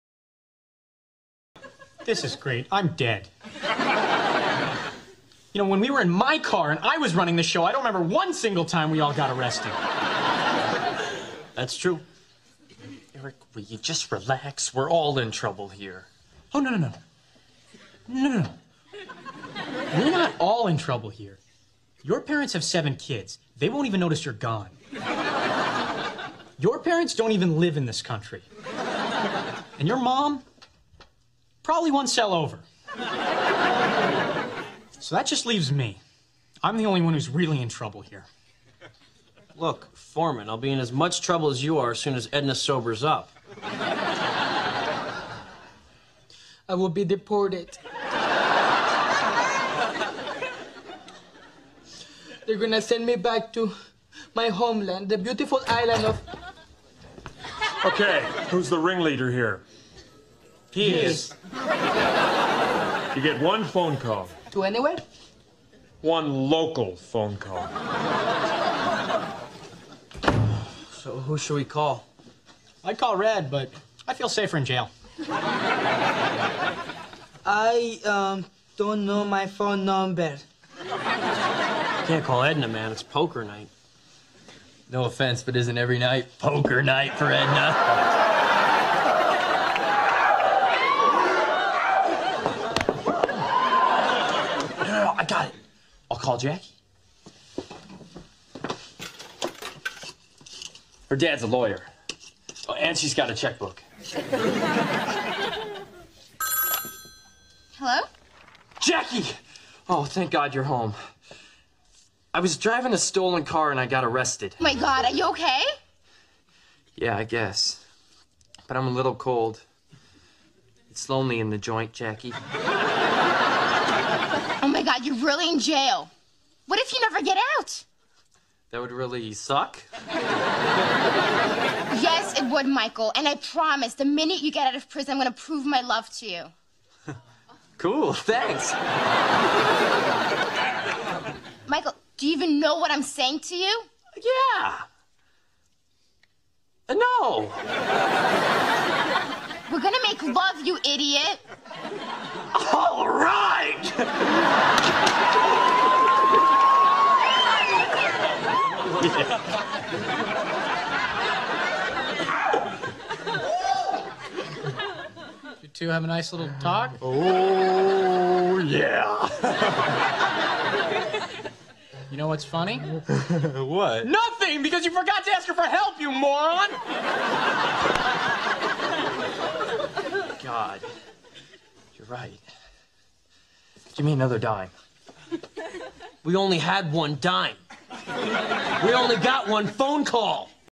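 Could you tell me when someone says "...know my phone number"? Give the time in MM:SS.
01:19.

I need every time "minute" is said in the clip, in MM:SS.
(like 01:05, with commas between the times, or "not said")
02:14.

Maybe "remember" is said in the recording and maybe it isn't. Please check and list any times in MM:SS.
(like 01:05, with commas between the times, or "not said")
00:07.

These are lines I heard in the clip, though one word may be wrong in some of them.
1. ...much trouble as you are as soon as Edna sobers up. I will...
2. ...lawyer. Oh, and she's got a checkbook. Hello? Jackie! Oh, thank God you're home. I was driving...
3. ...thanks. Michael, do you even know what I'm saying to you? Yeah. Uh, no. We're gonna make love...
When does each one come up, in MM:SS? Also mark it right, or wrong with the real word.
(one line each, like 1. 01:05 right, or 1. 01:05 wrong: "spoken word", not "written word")
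1. 00:40 right
2. 01:41 right
3. 02:18 right.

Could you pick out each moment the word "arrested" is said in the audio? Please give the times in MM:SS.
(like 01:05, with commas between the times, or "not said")
00:09, 01:54.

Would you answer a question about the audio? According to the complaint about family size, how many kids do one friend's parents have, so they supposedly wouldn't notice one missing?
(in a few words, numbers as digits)
7.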